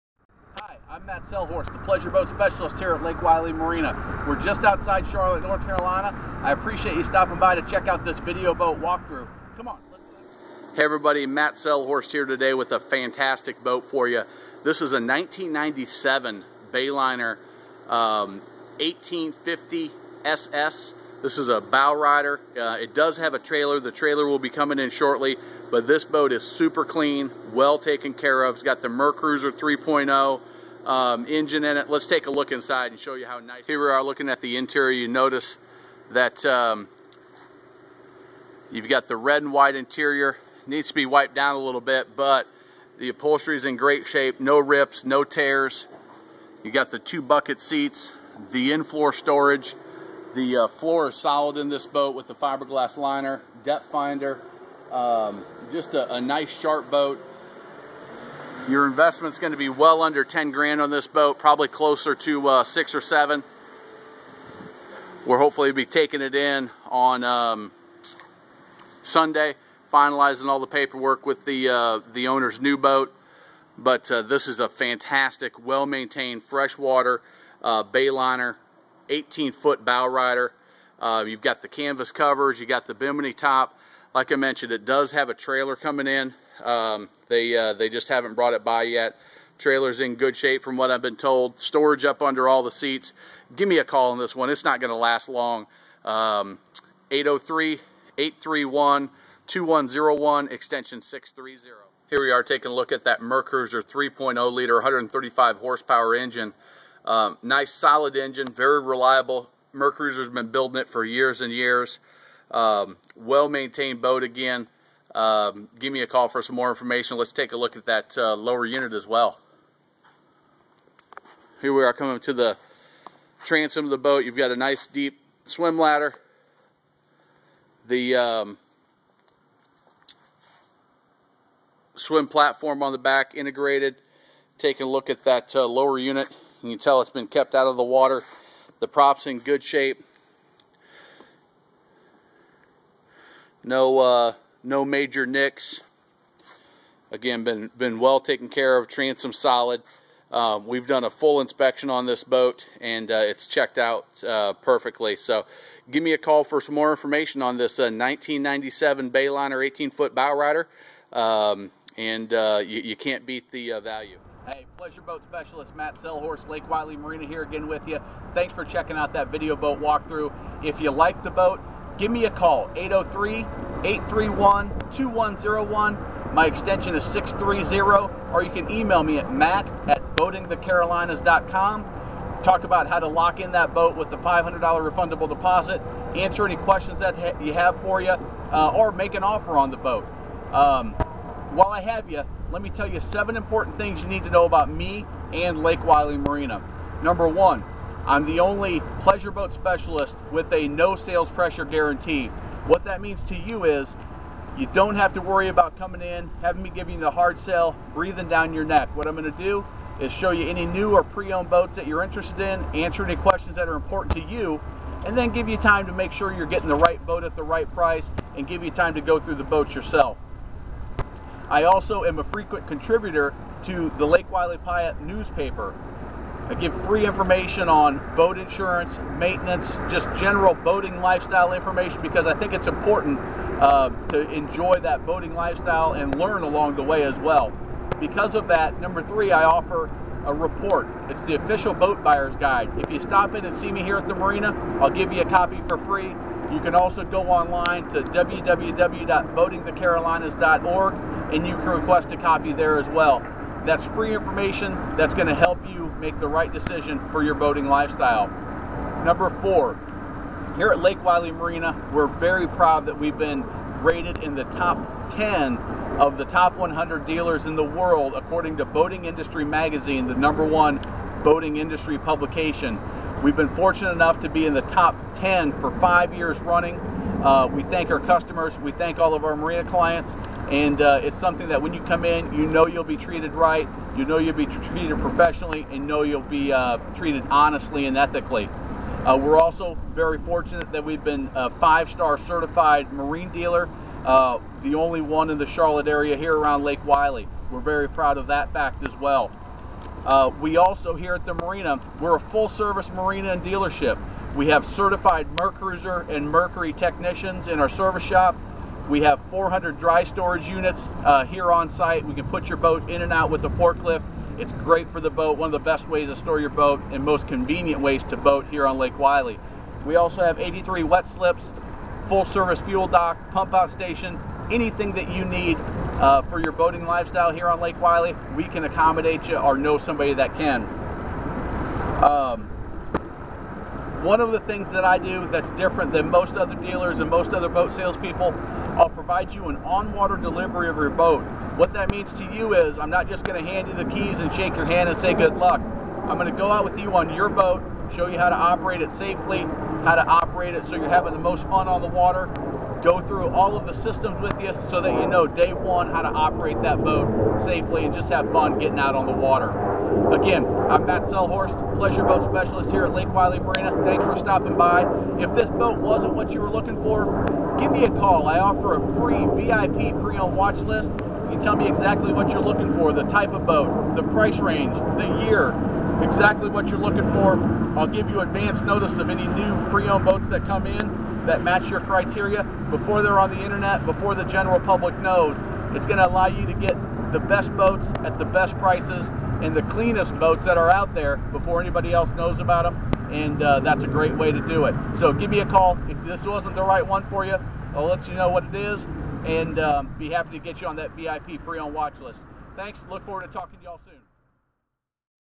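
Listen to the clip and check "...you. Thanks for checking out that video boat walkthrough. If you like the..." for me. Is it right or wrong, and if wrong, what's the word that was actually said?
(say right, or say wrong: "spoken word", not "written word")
right.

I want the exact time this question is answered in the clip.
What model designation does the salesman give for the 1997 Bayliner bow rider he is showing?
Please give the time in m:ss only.
0:18.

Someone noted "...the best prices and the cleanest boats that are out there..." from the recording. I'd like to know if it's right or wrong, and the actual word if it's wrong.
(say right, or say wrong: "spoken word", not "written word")
right.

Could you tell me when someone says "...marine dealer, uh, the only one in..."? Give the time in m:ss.
4:52.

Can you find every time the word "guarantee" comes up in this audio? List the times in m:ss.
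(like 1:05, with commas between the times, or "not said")
3:21.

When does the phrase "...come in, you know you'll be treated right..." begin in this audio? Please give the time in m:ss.
4:41.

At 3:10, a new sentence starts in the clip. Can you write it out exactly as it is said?
Um, while I have you, let me tell you seven important things you need to know about me and Lake Wylie Marina.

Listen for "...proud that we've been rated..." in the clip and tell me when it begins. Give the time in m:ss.
4:22.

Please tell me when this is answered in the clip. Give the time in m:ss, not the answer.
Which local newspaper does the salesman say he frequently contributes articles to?
3:44.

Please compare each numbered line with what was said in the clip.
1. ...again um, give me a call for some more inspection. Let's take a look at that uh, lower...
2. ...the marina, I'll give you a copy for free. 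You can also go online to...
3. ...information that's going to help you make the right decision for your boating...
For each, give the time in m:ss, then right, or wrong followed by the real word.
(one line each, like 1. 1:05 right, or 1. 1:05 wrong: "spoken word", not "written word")
1. 1:54 wrong: "information", not "inspection"
2. 4:04 right
3. 4:14 right.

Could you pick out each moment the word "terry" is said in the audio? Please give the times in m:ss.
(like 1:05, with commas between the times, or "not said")
not said.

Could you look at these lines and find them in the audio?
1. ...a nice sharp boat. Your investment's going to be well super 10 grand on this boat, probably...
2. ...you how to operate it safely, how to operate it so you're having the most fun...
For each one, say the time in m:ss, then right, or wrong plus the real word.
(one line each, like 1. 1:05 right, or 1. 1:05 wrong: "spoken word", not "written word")
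1. 0:56 wrong: "under", not "super"
2. 5:48 right.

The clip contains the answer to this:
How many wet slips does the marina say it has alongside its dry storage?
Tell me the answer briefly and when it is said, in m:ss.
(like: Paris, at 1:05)
83, at 5:20.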